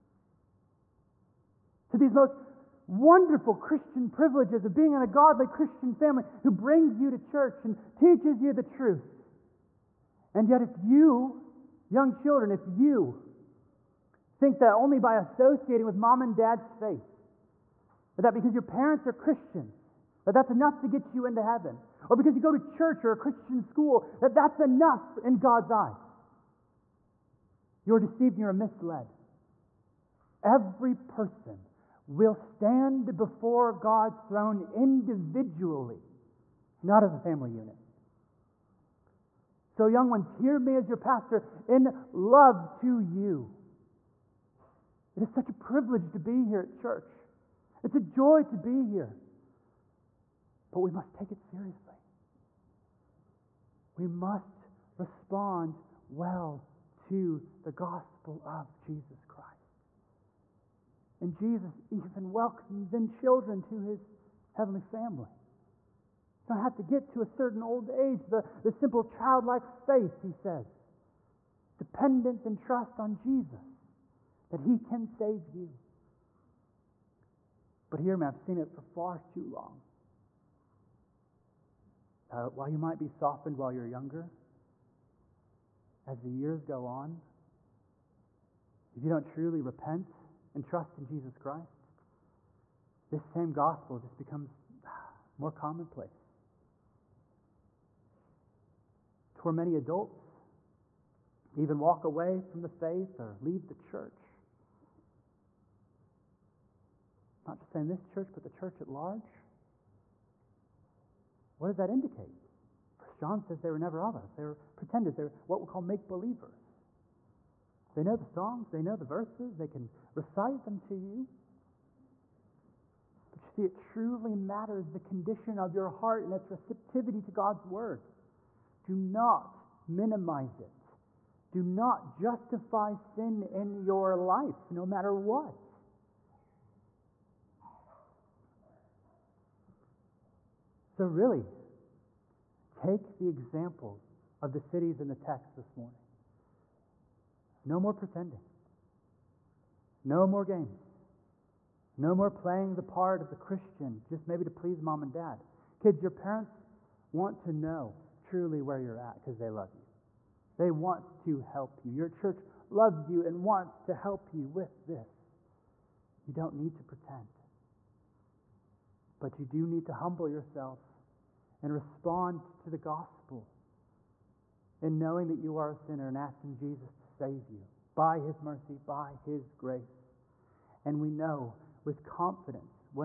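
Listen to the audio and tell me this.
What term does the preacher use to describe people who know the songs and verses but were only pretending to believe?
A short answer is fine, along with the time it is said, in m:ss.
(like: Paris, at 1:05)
make believers, at 1:55.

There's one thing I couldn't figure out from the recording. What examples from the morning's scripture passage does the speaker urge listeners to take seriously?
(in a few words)
the cities.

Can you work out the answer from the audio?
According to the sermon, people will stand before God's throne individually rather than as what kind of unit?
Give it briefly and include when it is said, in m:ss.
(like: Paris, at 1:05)
a family unit, at 0:37.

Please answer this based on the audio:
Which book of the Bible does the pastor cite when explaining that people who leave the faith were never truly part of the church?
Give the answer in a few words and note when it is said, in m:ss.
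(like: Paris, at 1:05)
First John, at 1:52.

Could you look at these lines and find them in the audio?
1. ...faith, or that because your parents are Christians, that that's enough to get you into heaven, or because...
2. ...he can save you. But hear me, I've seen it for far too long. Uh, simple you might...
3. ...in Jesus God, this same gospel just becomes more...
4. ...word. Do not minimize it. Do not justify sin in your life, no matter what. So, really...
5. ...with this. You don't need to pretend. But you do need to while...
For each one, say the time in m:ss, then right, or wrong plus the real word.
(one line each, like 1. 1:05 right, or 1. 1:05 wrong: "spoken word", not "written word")
1. 0:16 right
2. 1:14 wrong: "while", not "simple"
3. 1:30 wrong: "Christ", not "God"
4. 2:07 right
5. 2:44 wrong: "humble", not "while".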